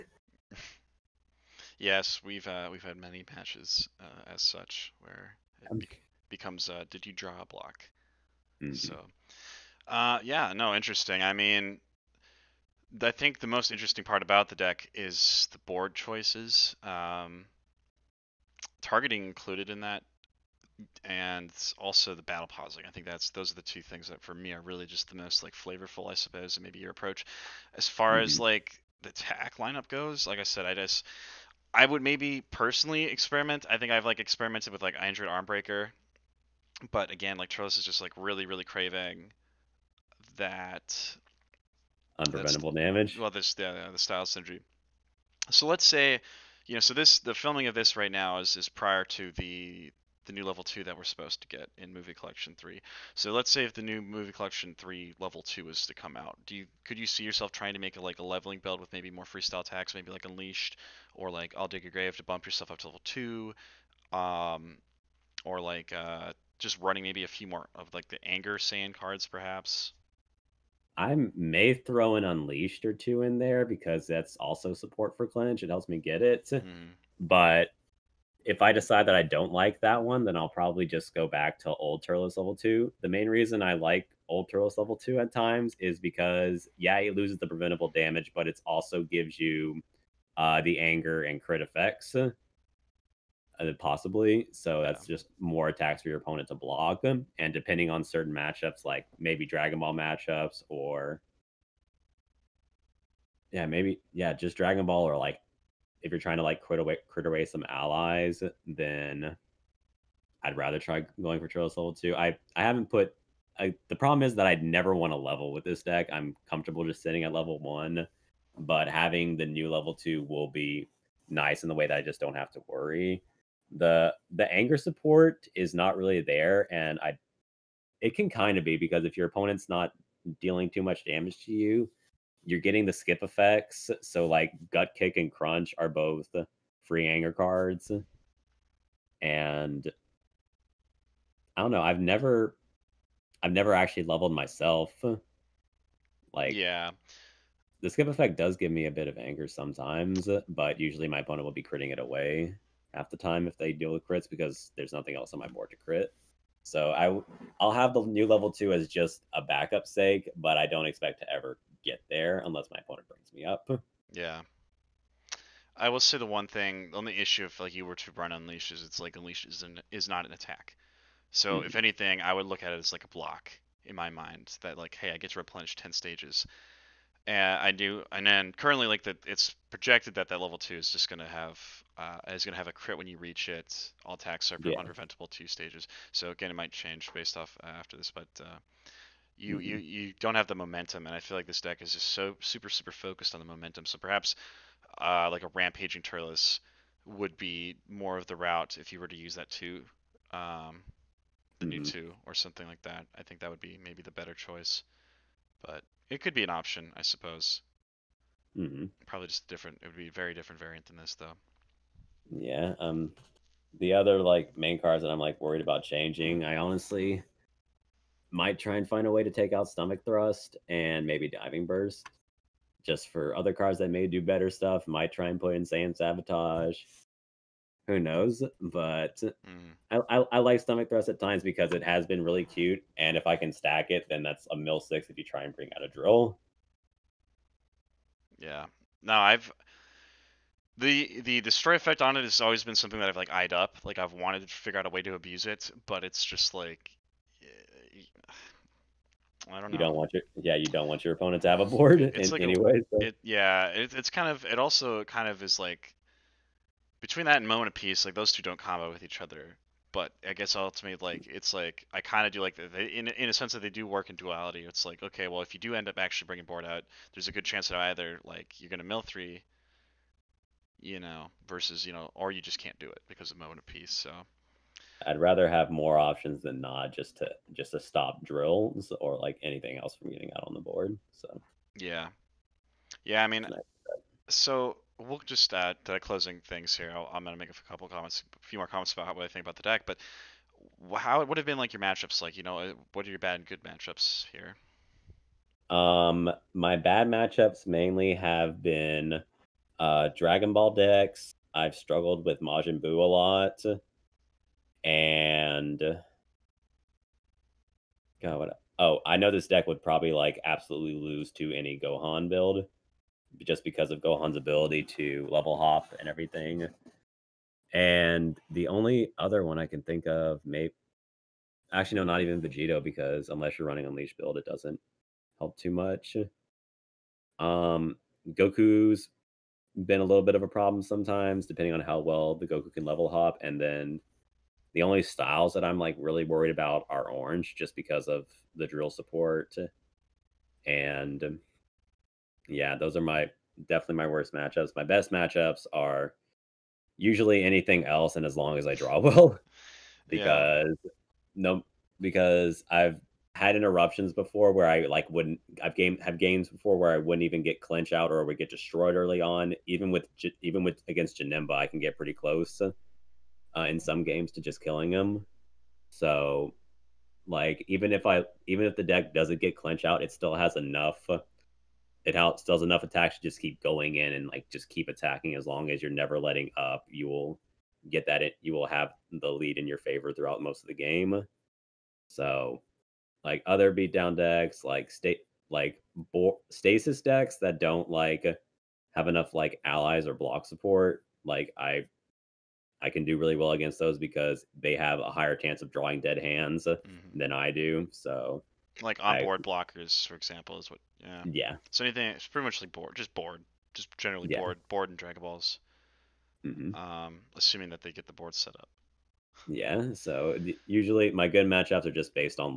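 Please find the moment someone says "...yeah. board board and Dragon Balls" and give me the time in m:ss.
6:44.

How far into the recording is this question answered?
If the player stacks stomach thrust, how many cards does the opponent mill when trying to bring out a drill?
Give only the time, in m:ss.
3:54.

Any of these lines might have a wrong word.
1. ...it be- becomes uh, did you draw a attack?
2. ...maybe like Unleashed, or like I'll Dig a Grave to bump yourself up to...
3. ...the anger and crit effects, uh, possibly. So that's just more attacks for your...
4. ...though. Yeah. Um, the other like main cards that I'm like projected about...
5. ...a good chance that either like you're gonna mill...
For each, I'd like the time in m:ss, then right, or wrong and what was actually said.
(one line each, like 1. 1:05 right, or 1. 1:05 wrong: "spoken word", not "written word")
1. 0:05 wrong: "block", not "attack"
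2. 0:59 right
3. 1:30 right
4. 3:31 wrong: "worried", not "projected"
5. 4:27 right.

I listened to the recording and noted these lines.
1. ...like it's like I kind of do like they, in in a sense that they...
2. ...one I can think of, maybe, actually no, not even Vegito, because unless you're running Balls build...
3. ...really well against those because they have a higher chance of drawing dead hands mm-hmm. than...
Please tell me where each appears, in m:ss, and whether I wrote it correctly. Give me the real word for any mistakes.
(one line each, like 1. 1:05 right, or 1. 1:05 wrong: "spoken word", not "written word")
1. 4:21 right
2. 5:19 wrong: "Unleash", not "Balls"
3. 6:33 right.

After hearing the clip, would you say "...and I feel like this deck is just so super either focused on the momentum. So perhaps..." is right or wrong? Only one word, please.
wrong.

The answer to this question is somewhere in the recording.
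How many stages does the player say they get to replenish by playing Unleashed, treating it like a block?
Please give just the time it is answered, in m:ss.
2:55.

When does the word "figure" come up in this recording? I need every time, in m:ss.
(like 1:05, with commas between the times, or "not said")
4:04.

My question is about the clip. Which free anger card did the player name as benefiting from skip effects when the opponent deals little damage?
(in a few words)
gut kick.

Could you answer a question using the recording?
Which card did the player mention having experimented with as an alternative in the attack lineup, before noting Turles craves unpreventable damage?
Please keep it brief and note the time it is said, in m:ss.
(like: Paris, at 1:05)
Android Armbreaker, at 0:34.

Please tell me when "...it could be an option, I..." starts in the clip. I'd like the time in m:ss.
3:26.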